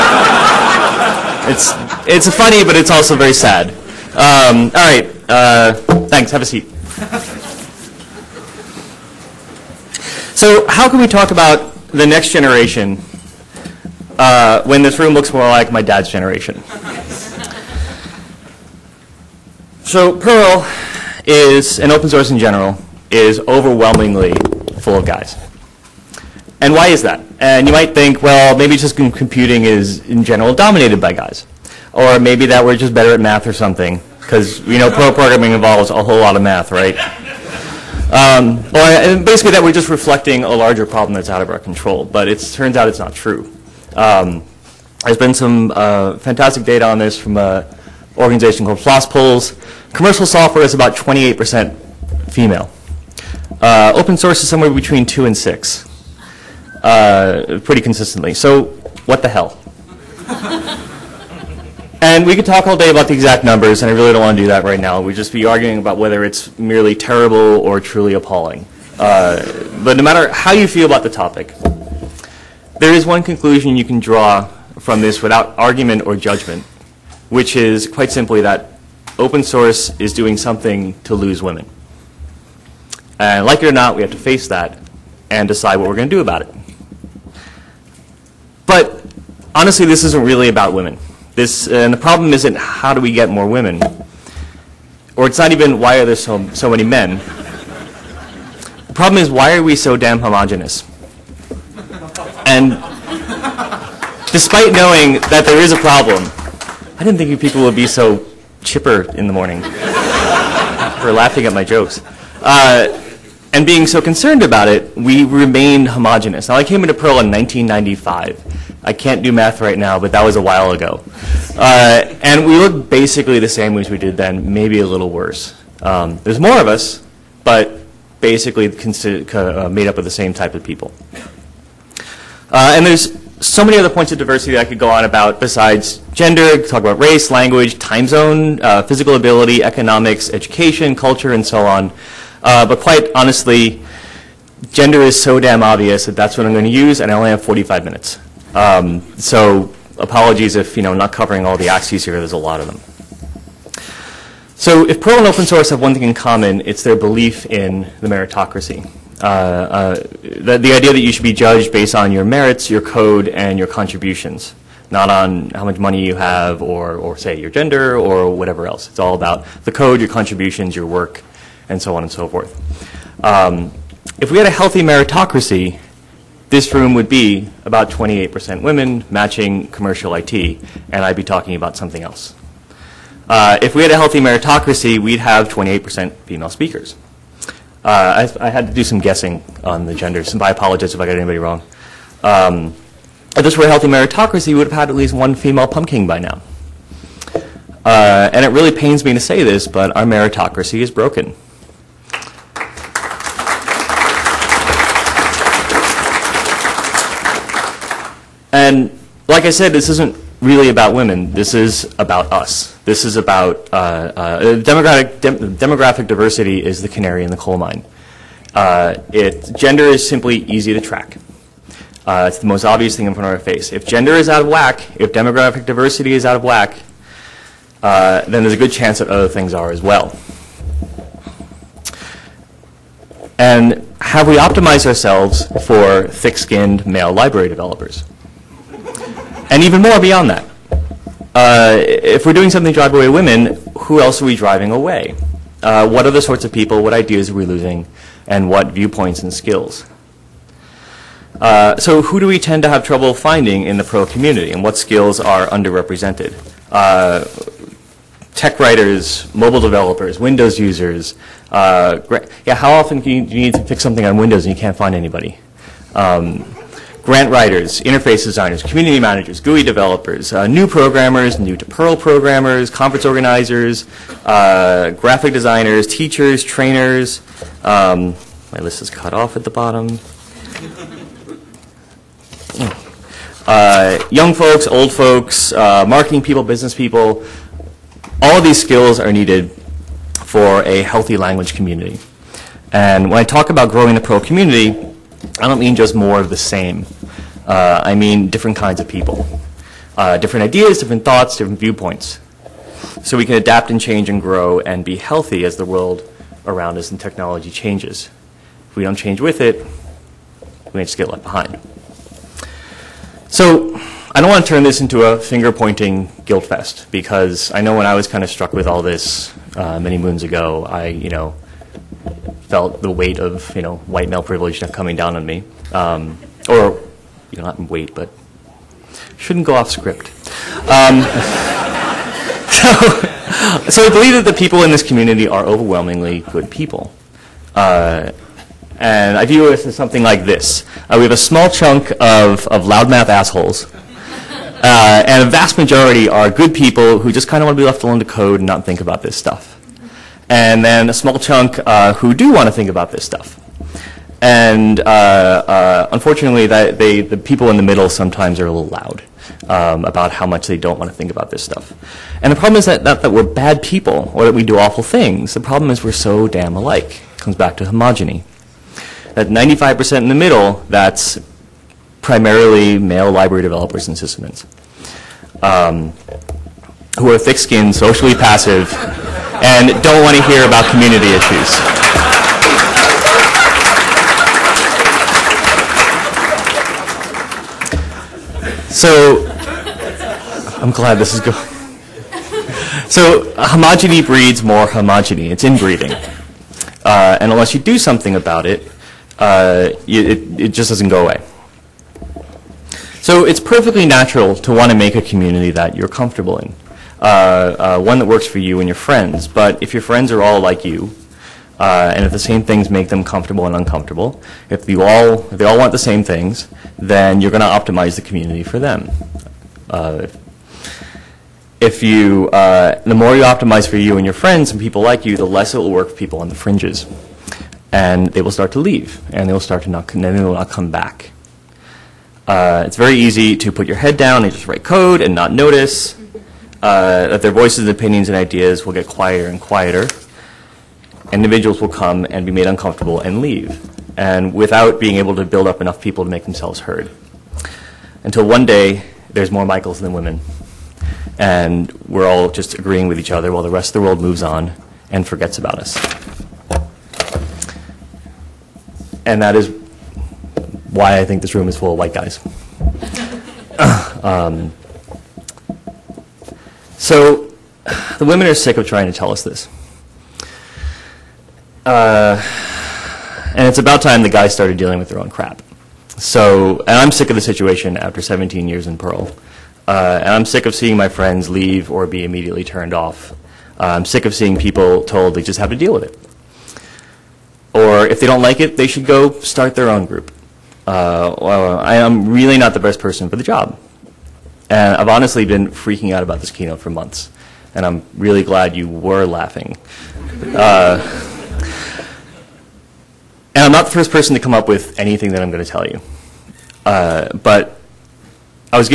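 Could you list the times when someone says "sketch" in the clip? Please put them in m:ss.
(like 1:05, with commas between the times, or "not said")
not said.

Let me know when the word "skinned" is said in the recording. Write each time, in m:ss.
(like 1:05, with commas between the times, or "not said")
3:56, 6:17.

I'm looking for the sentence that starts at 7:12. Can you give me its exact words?
it's very easy to put your head down and just write code and not notice.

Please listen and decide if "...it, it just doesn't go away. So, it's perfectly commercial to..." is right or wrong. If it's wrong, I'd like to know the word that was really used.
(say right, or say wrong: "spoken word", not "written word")
wrong: "natural", not "commercial".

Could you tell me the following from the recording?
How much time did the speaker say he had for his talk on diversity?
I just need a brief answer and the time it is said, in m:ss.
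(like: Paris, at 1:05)
45 minutes, at 2:27.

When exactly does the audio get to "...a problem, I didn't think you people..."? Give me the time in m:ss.
1:45.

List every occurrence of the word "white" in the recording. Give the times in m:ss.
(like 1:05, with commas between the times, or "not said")
5:23, 7:41.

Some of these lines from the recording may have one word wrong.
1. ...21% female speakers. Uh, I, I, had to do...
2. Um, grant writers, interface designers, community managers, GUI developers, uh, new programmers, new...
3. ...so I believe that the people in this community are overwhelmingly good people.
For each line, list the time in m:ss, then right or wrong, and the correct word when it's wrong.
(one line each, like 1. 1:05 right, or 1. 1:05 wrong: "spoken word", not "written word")
1. 3:05 wrong: "28", not "21"
2. 4:25 right
3. 5:33 right.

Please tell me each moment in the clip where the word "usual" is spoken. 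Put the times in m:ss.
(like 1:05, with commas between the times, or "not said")
not said.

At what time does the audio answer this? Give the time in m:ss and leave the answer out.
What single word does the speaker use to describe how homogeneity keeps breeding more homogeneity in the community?
6:35.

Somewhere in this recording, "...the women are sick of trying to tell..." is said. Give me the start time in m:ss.
7:47.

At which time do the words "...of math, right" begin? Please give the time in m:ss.
0:36.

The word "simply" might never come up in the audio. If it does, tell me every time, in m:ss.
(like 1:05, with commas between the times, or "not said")
1:18, 3:40.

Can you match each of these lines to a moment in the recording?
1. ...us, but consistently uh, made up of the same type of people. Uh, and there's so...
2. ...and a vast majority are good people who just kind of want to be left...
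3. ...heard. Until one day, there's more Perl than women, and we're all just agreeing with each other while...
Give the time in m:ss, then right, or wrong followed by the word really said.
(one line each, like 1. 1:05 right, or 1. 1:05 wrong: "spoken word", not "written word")
1. 2:06 wrong: "basically", not "consistently"
2. 5:45 right
3. 7:26 wrong: "Michaels", not "Perl".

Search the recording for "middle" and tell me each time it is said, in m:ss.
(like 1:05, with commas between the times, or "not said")
5:57, 6:10.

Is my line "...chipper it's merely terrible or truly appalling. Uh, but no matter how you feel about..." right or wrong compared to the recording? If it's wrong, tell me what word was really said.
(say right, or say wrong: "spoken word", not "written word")
wrong: "whether", not "chipper".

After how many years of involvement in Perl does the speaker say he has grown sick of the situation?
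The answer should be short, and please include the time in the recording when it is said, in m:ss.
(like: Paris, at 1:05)
17, at 7:58.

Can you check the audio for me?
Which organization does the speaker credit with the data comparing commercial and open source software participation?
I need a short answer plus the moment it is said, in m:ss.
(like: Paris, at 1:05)
Polls, at 0:48.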